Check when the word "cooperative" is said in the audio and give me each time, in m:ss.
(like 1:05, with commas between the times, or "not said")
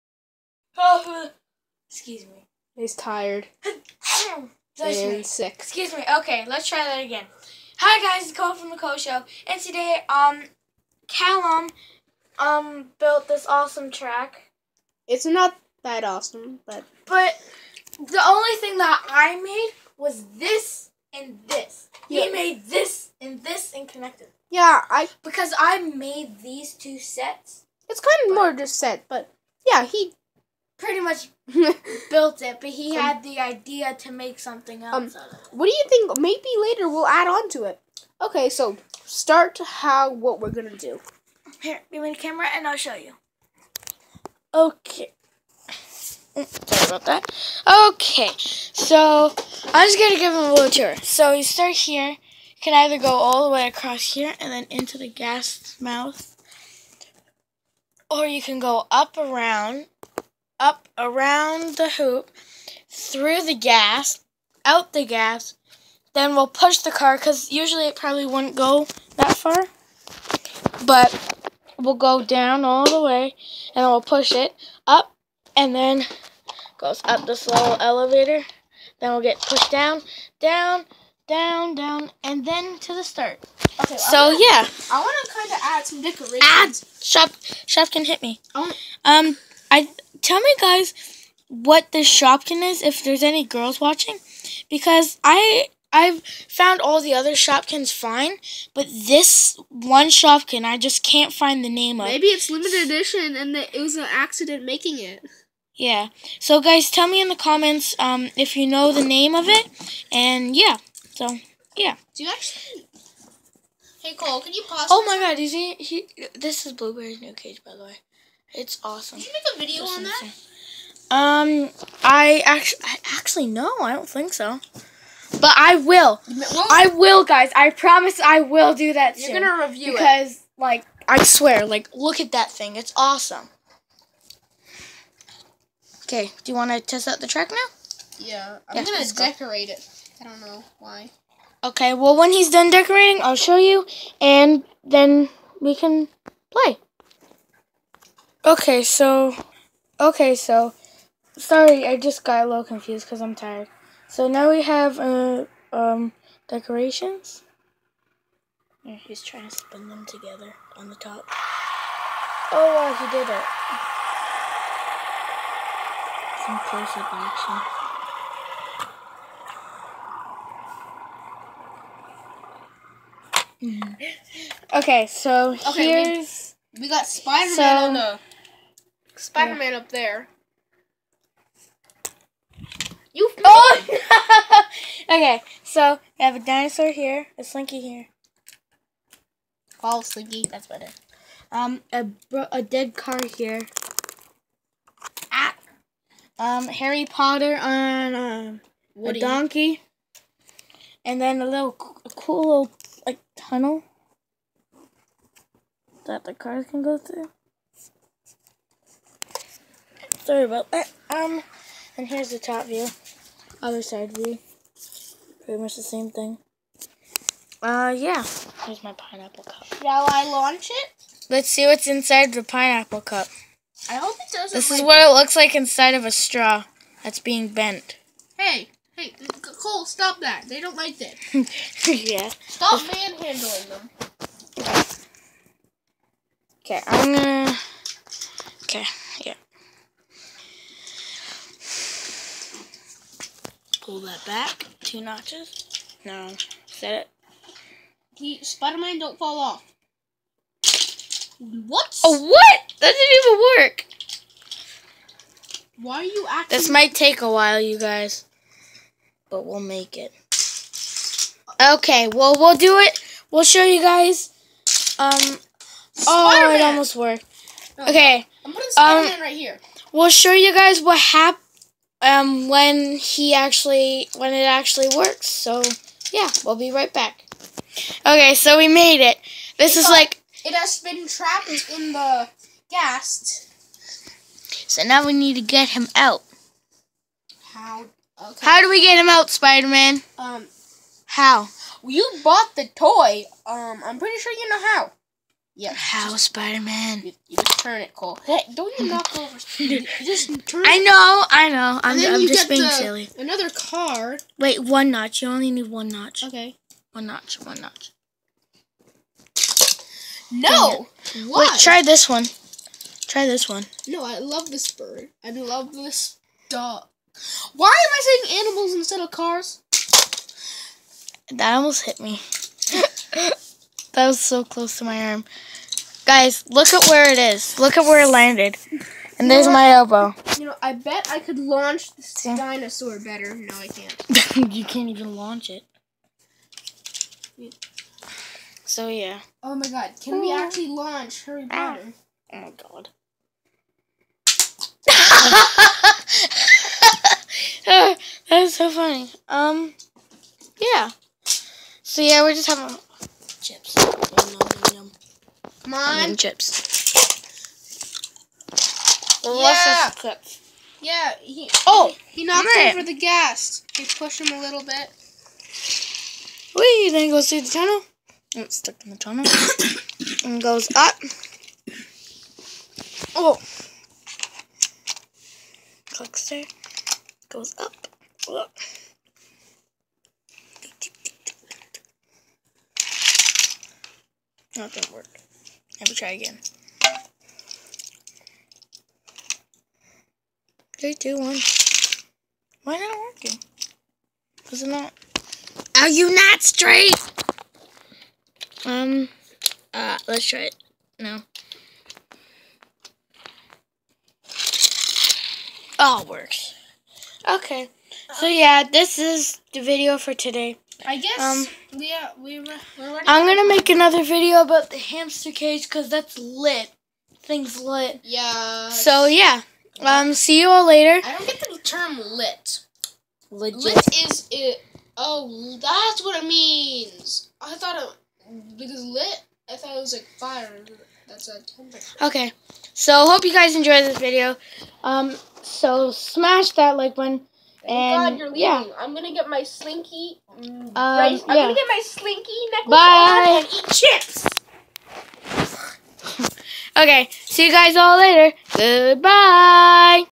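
not said.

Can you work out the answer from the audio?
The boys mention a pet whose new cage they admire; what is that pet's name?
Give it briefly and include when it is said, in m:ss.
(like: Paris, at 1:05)
Blueberry, at 1:56.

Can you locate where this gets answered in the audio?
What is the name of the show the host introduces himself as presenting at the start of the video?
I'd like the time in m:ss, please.
0:08.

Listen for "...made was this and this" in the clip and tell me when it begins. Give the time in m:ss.
0:19.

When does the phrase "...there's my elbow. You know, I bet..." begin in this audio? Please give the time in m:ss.
5:29.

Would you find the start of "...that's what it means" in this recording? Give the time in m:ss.
7:05.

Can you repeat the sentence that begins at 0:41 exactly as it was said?
Here, give me the camera and I'll show you.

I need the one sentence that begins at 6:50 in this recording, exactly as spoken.
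I guess um, we are, uh, we were, I'm going to make another video about the hamster cage because that's lit.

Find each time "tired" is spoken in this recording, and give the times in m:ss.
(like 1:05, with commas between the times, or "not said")
0:02, 2:33.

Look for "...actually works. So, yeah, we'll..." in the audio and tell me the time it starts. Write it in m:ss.
4:34.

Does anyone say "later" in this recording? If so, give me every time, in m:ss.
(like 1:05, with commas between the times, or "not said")
0:36, 7:00, 7:27.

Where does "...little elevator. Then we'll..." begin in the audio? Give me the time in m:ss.
1:17.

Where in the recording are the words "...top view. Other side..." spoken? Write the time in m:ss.
3:32.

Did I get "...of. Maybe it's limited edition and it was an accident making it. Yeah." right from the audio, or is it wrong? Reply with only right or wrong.
right.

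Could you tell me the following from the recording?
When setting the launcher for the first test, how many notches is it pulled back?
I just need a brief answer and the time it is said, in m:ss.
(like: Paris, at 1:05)
2, at 4:04.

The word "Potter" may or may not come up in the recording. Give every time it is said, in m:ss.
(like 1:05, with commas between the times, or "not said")
3:17, 5:41.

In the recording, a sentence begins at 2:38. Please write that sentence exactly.
he's trying to spin them together on the top.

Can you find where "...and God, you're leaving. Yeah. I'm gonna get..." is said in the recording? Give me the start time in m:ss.
7:17.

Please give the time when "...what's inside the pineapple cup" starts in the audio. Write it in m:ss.
3:41.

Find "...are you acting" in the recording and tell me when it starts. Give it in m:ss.
4:15.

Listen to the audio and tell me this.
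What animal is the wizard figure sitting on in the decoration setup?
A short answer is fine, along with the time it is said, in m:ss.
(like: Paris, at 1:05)
A donkey, at 3:19.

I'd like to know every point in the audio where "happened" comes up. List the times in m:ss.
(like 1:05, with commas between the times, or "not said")
4:30.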